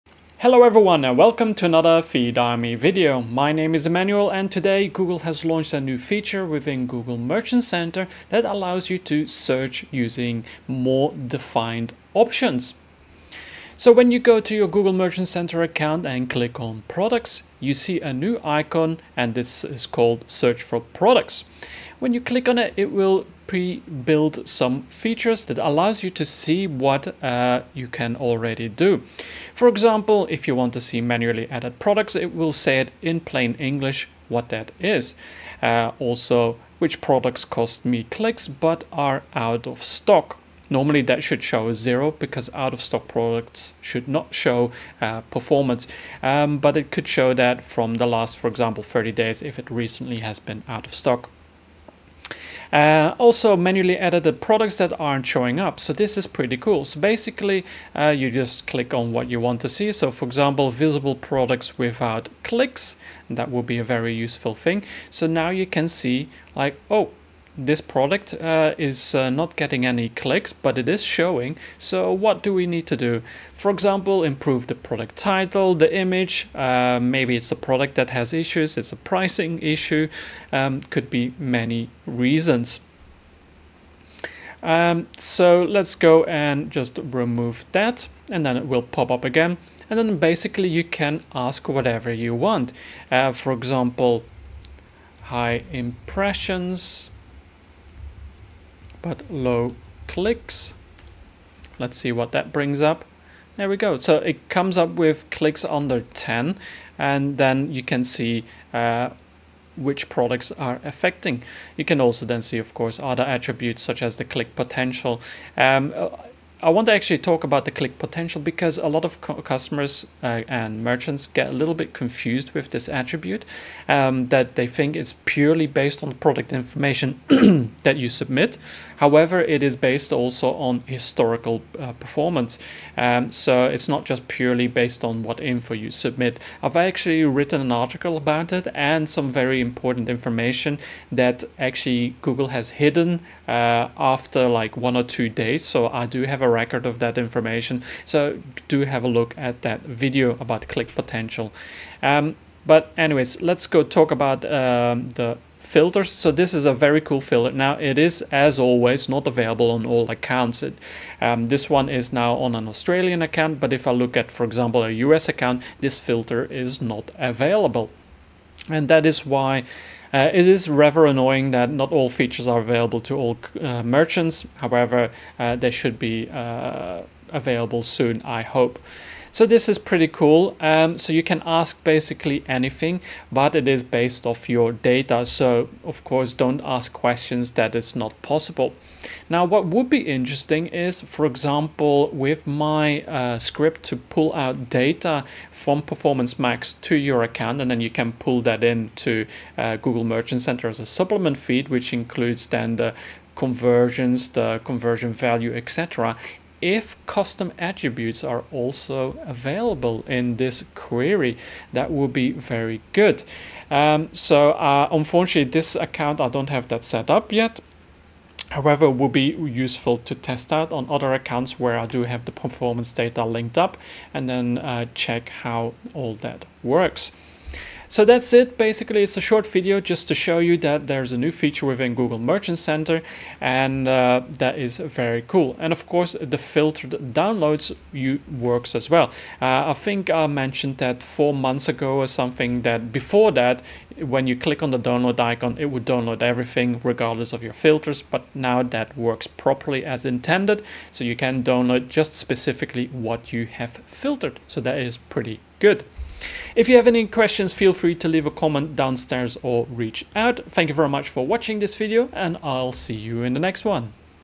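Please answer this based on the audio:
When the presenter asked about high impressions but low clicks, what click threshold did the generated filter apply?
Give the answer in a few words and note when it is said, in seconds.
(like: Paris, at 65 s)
under 10, at 105 s.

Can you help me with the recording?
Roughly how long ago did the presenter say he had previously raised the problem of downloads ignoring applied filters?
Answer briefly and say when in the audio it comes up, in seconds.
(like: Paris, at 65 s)
4 months, at 241 s.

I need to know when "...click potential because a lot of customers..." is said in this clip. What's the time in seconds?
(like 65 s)
117 s.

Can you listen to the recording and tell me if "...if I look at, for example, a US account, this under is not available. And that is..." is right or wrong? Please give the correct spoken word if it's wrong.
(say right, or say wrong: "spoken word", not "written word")
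wrong: "filter", not "under".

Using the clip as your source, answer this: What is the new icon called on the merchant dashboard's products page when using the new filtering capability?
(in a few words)
search for products.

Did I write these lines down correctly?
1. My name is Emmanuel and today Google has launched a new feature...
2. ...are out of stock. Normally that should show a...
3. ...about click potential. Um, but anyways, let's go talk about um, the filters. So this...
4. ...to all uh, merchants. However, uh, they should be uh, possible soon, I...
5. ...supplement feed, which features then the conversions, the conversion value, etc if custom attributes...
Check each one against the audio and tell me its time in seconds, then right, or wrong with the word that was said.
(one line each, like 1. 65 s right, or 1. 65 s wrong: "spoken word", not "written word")
1. 3 s right
2. 38 s right
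3. 150 s right
4. 173 s wrong: "available", not "possible"
5. 200 s wrong: "includes", not "features".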